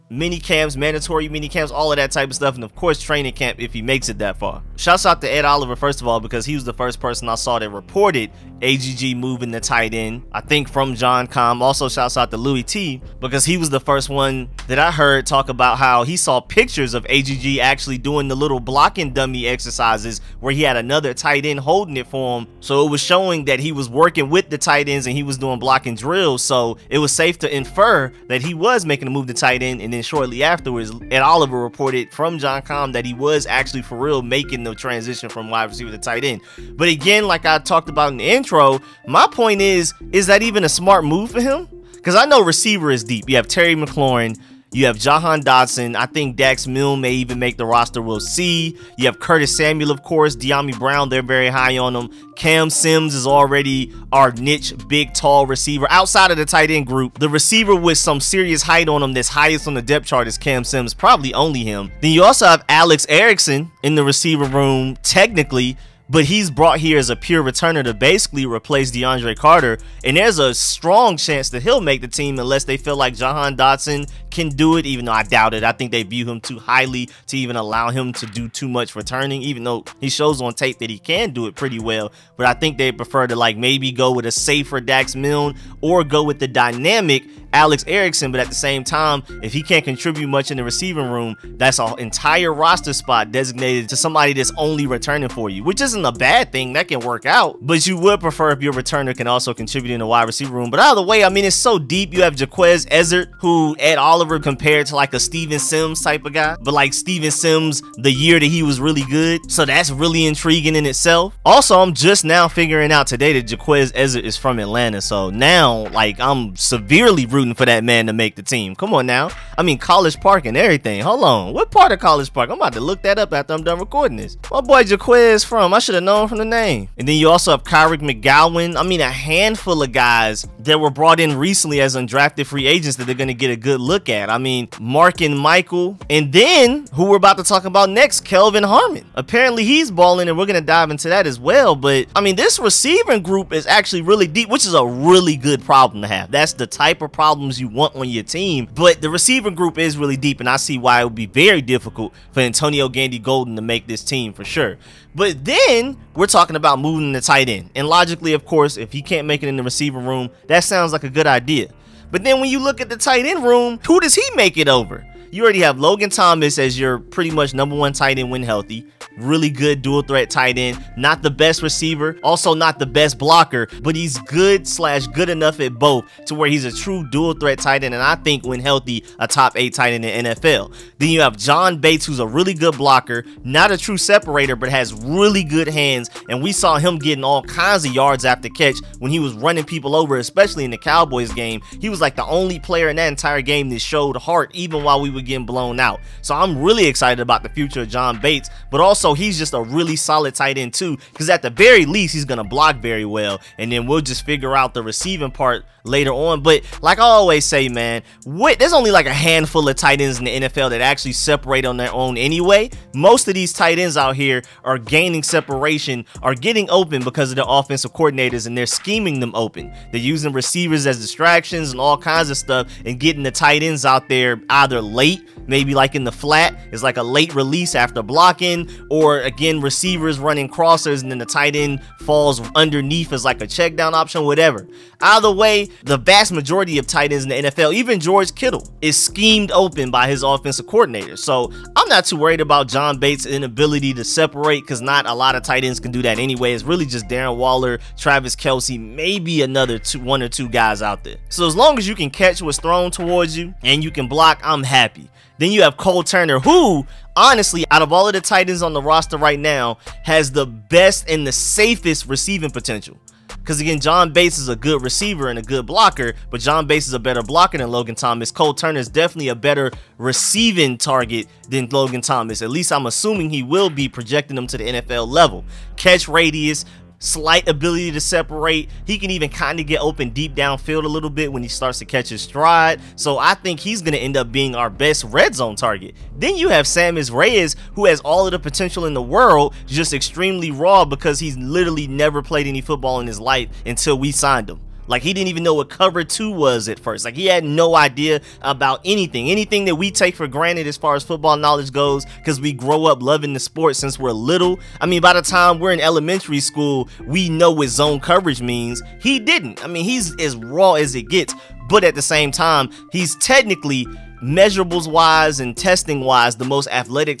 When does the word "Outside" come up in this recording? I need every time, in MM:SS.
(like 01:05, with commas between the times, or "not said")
00:55.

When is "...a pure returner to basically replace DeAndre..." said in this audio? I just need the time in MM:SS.
01:07.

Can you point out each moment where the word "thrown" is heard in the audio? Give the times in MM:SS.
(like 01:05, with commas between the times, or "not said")
04:12.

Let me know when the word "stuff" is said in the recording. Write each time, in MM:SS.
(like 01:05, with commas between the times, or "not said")
00:02, 03:42.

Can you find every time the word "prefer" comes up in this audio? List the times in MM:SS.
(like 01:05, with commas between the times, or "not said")
01:22, 01:38.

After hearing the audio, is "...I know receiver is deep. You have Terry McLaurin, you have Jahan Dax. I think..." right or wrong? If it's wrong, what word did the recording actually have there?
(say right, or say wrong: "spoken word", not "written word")
wrong: "Dotson", not "Dax".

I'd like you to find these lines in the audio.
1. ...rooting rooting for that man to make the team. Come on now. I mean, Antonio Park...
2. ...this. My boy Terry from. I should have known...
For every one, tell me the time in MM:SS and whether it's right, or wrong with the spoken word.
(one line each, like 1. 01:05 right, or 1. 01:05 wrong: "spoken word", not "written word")
1. 01:57 wrong: "College", not "Antonio"
2. 02:04 wrong: "Jequez", not "Terry".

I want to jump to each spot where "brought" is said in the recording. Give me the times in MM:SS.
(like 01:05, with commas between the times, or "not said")
01:06, 02:10.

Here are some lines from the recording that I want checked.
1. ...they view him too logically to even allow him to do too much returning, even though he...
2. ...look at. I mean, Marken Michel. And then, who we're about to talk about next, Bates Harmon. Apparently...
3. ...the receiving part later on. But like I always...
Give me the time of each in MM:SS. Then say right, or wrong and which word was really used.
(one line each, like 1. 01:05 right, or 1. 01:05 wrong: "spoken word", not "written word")
1. 01:15 wrong: "highly", not "logically"
2. 02:13 wrong: "Kelvin", not "Bates"
3. 03:24 right.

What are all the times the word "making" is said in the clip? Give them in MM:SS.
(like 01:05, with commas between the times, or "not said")
00:28, 00:34.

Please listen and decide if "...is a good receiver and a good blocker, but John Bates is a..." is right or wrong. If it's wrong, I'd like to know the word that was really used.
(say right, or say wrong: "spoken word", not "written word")
right.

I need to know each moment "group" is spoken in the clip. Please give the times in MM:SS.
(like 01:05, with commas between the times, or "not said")
00:56, 02:23, 02:29.